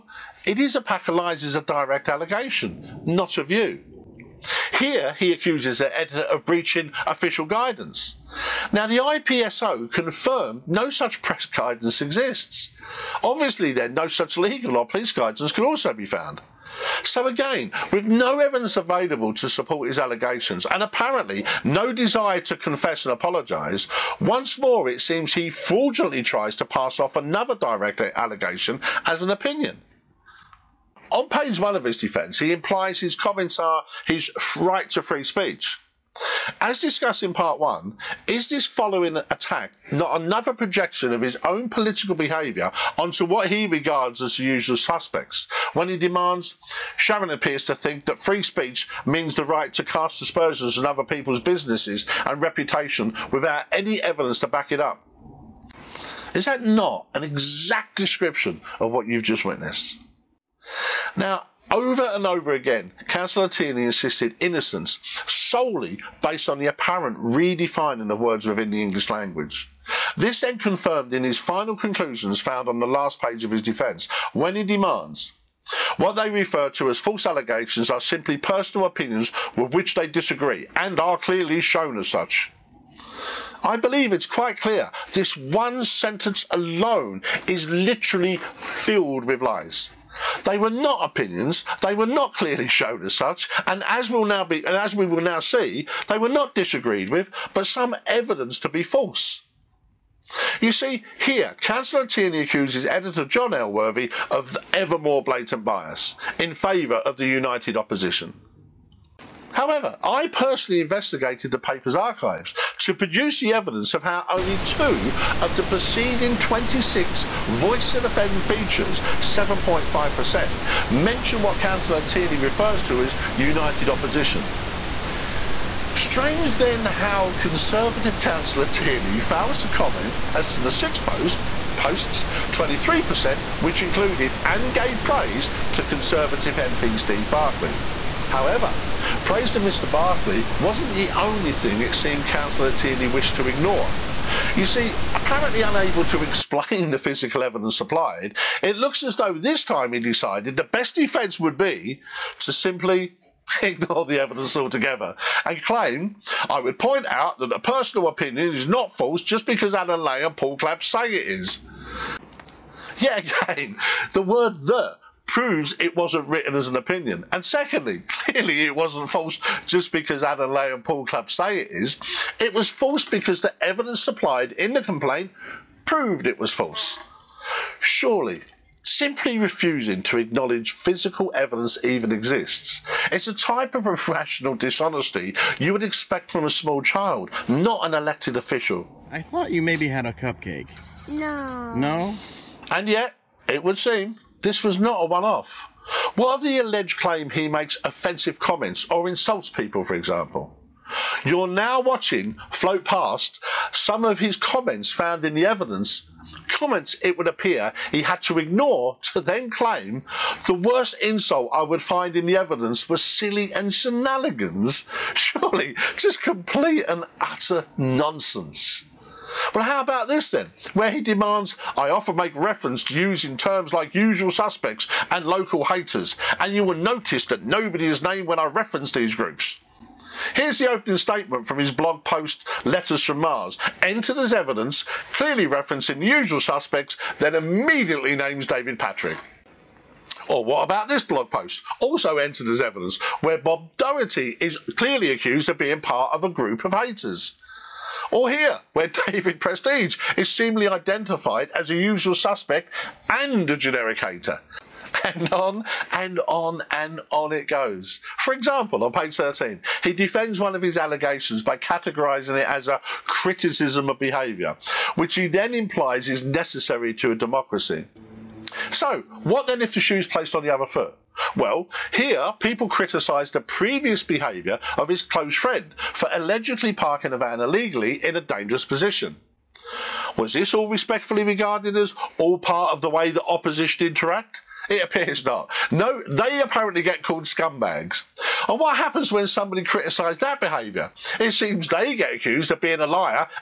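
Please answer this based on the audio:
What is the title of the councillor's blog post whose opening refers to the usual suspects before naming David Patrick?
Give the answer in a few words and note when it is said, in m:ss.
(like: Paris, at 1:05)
Letters from Mars, at 3:52.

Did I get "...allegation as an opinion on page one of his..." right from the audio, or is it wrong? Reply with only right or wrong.
right.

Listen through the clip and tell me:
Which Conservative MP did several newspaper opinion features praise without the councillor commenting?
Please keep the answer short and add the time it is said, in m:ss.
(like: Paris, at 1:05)
Steve Barclay, at 2:16.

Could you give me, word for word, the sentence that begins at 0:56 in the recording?
Is that not an exact description of what you've just witnessed?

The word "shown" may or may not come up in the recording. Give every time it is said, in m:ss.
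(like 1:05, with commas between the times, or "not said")
1:21, 1:32.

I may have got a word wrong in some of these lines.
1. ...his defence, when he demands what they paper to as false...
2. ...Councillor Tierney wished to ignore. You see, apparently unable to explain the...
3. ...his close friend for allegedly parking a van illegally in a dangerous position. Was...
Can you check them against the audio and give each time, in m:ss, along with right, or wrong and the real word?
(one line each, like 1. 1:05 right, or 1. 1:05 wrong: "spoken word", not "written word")
1. 1:13 wrong: "refer", not "paper"
2. 2:22 right
3. 4:34 right.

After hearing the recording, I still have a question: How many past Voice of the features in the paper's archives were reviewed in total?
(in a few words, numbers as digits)
26.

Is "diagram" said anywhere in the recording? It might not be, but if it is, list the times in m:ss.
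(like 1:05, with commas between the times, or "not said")
not said.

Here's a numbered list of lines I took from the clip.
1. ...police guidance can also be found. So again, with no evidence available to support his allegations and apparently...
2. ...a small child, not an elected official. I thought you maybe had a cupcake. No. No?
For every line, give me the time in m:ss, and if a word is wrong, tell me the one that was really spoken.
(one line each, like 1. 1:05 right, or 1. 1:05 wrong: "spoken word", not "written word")
1. 0:14 right
2. 3:06 right.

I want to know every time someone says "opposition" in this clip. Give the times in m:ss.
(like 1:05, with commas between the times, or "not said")
1:47, 2:03, 4:43.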